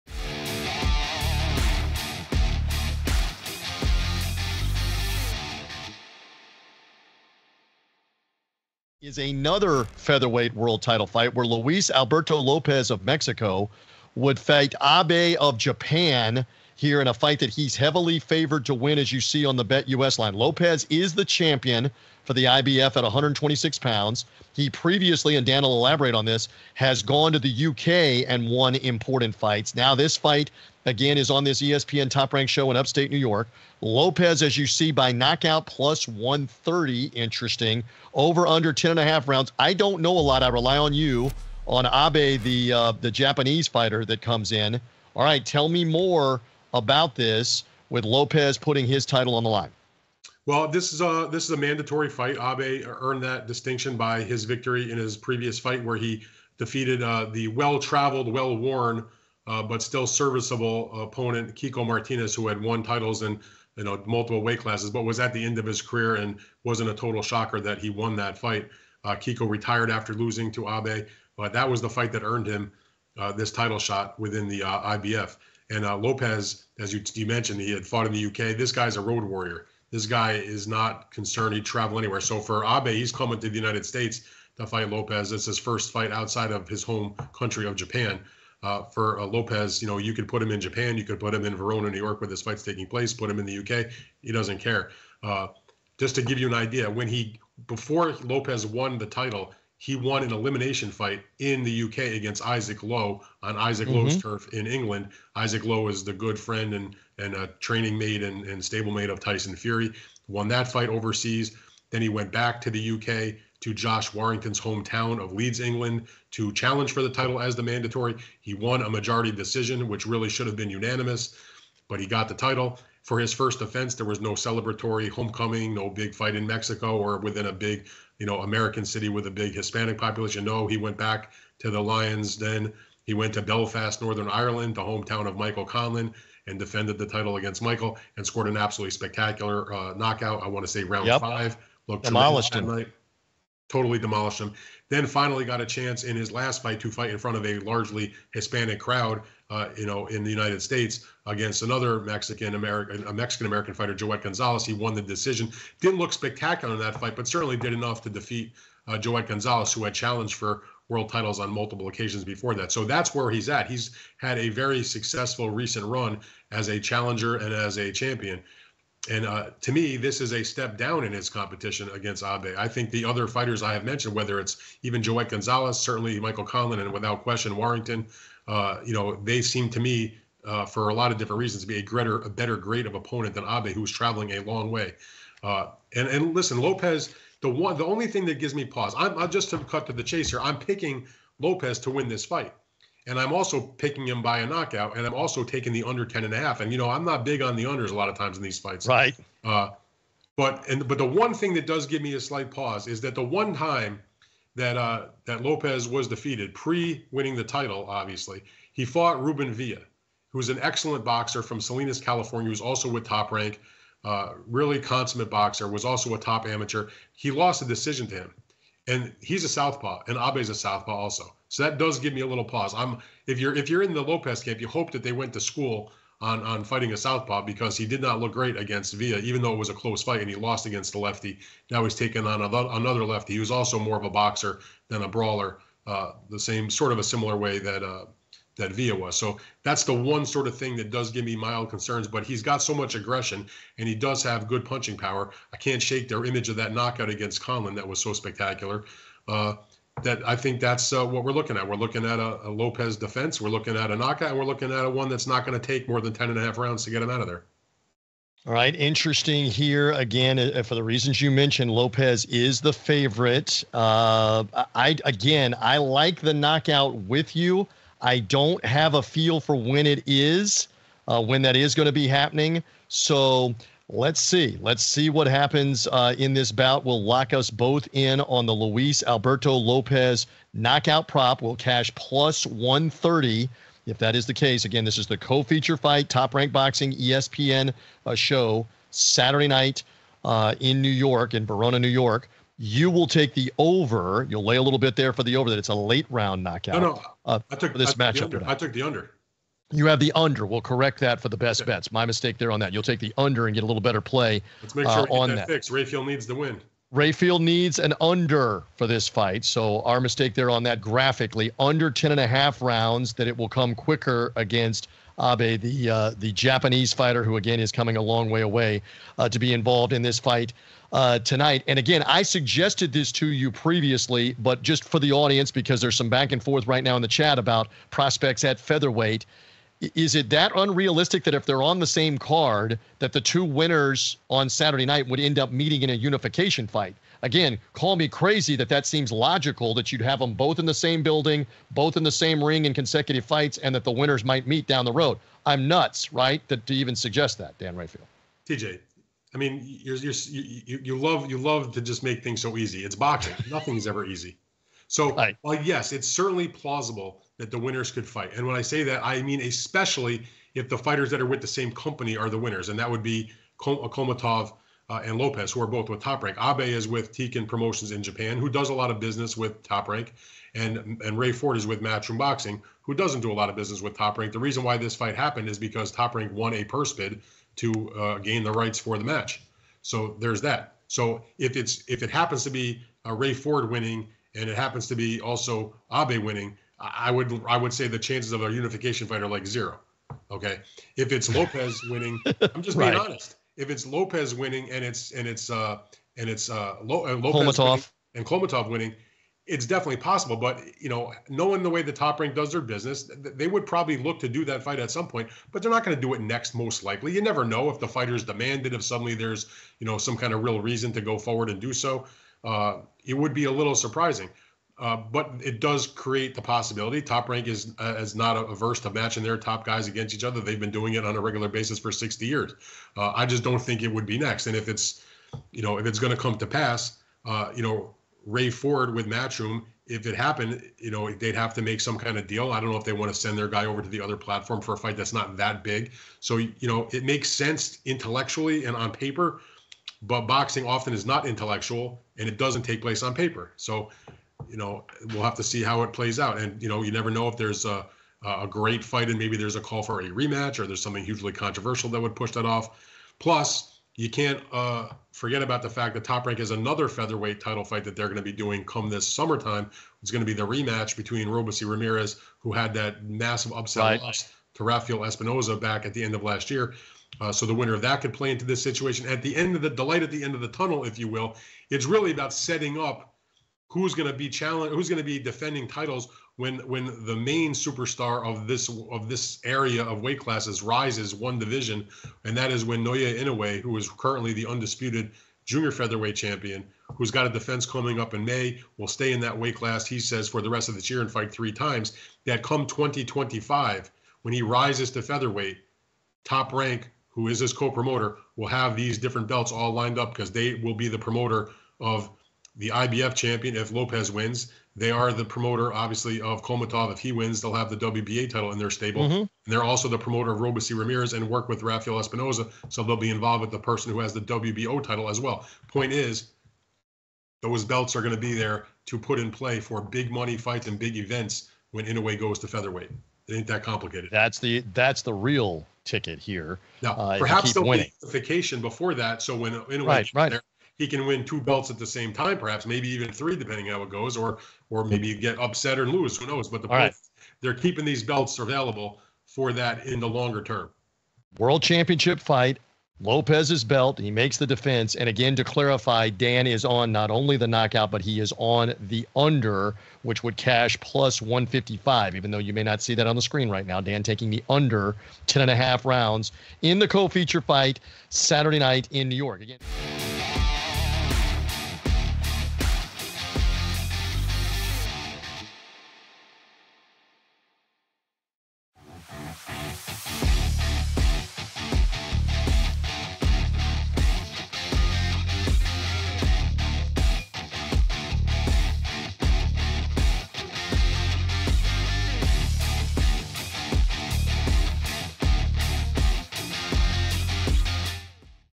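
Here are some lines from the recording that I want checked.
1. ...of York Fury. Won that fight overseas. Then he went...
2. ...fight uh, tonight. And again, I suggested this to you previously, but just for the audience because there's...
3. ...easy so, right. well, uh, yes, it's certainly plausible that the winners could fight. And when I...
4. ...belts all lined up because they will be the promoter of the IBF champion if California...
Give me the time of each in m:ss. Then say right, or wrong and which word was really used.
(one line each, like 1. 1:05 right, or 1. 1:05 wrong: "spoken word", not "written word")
1. 1:49 wrong: "Tyson", not "York"
2. 5:20 right
3. 5:54 right
4. 8:19 wrong: "Lopez", not "California".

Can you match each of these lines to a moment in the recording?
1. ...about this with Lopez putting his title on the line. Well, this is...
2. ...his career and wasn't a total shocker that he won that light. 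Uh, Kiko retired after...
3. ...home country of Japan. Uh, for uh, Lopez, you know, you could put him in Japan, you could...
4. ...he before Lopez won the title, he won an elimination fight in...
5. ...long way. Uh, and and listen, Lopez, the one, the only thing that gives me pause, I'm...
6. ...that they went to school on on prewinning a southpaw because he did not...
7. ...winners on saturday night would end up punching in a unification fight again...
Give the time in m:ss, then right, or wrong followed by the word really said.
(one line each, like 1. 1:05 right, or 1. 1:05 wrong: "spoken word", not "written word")
1. 0:46 right
2. 1:05 wrong: "fight", not "light"
3. 1:26 right
4. 1:37 right
5. 3:04 right
6. 3:44 wrong: "fighting", not "prewinning"
7. 5:33 wrong: "meeting", not "punching".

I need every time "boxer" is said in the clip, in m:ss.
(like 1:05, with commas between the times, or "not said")
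3:31, 3:35, 3:54.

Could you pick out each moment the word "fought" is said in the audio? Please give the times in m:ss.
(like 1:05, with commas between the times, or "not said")
1:17, 3:28.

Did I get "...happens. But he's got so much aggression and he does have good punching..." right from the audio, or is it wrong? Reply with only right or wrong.
wrong.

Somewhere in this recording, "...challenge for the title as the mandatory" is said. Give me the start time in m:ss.
1:56.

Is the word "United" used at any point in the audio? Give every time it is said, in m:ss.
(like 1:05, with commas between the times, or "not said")
1:23, 2:30.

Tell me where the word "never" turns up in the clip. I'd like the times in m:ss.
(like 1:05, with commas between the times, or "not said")
6:47, 7:26.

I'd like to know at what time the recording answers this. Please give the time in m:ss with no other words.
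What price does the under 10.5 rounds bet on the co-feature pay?
9:10.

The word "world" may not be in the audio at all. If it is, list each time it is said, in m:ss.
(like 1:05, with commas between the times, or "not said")
0:10, 2:40, 9:01.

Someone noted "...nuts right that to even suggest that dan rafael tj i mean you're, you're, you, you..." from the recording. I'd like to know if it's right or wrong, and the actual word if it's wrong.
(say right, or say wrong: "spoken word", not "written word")
right.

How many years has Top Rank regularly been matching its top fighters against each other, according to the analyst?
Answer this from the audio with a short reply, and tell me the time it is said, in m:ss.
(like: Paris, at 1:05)
60, at 7:01.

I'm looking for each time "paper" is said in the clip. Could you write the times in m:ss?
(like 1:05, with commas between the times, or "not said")
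7:18, 7:23.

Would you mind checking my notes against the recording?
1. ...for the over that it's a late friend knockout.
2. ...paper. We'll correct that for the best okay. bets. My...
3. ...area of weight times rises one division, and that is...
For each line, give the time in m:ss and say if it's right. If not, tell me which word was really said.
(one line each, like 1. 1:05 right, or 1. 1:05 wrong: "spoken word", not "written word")
1. 4:55 wrong: "round", not "friend"
2. 5:00 wrong: "under", not "paper"
3. 7:59 wrong: "classes", not "times".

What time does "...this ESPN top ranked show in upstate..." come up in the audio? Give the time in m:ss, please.
0:31.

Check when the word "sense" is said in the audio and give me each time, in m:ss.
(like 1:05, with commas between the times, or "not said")
7:17.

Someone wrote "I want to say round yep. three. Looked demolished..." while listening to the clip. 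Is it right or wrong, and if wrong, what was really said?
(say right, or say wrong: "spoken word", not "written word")
wrong: "five", not "three".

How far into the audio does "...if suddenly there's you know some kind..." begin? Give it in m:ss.
6:48.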